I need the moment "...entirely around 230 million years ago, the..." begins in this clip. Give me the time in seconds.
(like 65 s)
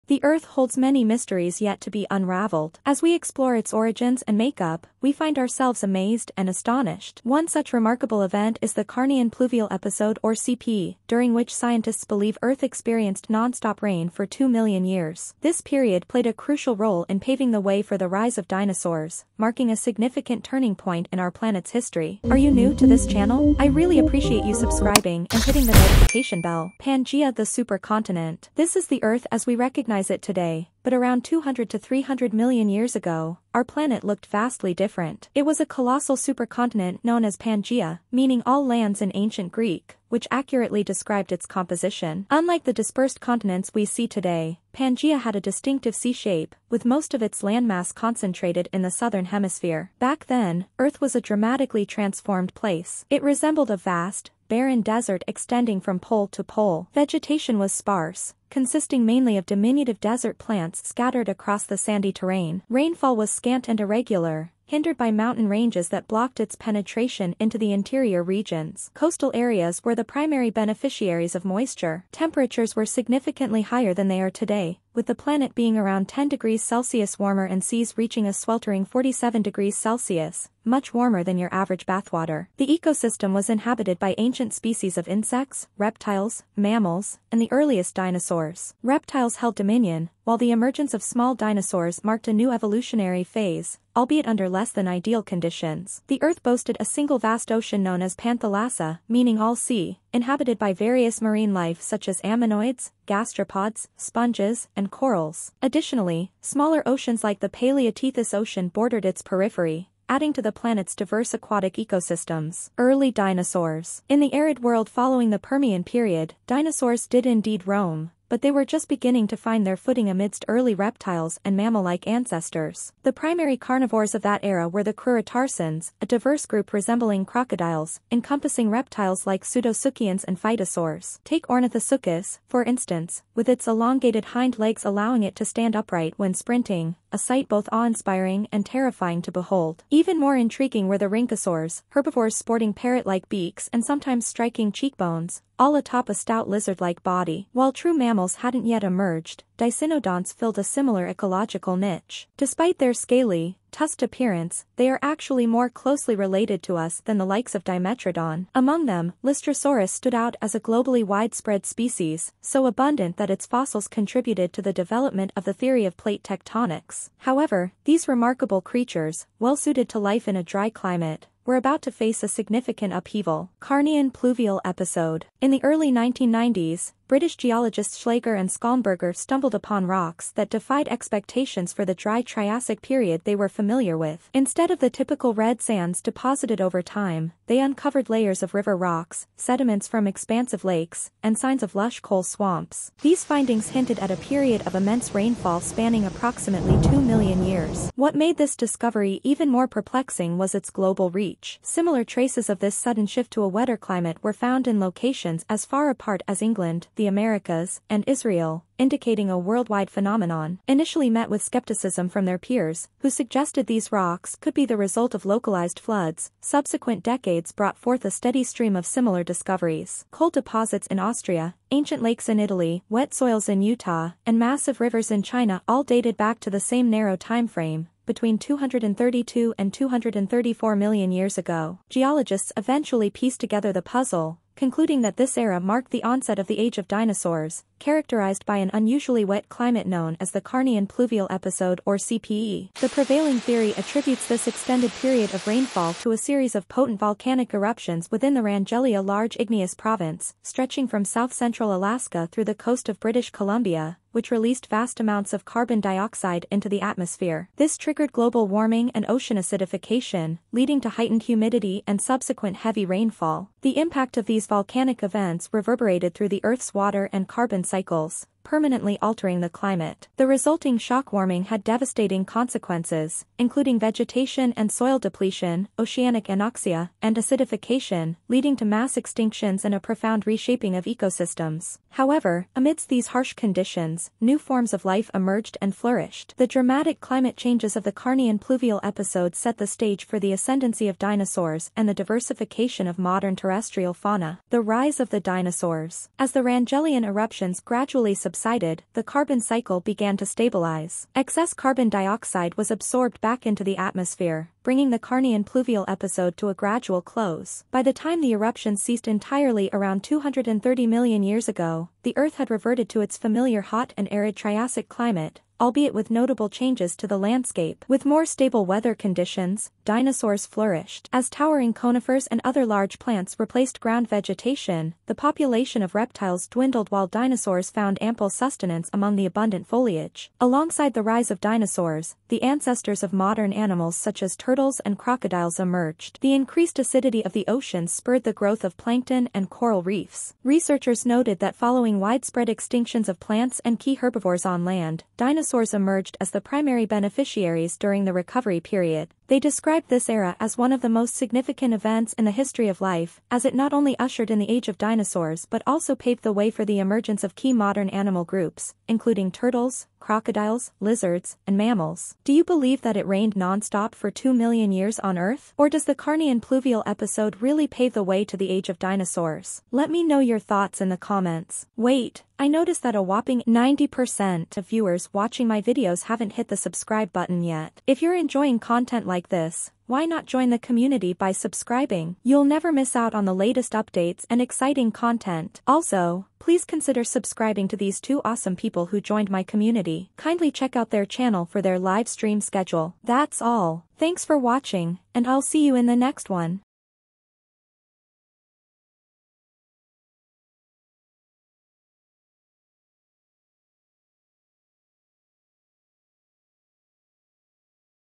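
309 s.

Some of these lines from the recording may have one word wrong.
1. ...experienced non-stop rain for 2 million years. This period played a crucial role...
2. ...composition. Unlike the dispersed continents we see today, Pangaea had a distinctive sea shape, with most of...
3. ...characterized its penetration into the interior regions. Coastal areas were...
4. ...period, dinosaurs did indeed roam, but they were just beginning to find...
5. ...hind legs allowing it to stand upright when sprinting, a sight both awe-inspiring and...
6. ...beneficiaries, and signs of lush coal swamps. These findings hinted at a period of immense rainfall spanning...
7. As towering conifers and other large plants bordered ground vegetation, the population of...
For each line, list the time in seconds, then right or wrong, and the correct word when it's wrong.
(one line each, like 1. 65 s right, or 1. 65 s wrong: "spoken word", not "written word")
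1. 12 s right
2. 41 s right
3. 66 s wrong: "blocked", not "characterized"
4. 115 s right
5. 134 s right
6. 190 s wrong: "lakes", not "beneficiaries"
7. 321 s wrong: "replaced", not "bordered".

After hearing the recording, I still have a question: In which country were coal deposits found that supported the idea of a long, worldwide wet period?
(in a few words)
Austria.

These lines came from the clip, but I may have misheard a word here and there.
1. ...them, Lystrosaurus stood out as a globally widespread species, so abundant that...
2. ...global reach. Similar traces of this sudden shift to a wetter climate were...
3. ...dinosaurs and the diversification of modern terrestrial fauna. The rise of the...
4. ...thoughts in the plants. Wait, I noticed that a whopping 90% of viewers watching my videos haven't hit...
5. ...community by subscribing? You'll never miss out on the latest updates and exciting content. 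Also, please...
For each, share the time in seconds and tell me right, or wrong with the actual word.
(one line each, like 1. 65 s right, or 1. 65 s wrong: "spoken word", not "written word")
1. 158 s right
2. 200 s right
3. 290 s right
4. 370 s wrong: "comments", not "plants"
5. 380 s right.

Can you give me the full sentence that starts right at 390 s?
Kindly check out their channel for their live stream schedule.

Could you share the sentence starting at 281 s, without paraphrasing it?
However, amidst these harsh conditions, new forms of life emerged and flourished.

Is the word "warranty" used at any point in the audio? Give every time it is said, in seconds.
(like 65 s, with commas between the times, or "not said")
not said.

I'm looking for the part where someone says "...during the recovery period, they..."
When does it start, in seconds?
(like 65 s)
347 s.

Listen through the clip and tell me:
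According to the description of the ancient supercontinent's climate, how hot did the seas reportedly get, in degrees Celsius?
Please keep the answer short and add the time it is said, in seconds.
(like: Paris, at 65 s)
47 degrees Celsius, at 78 s.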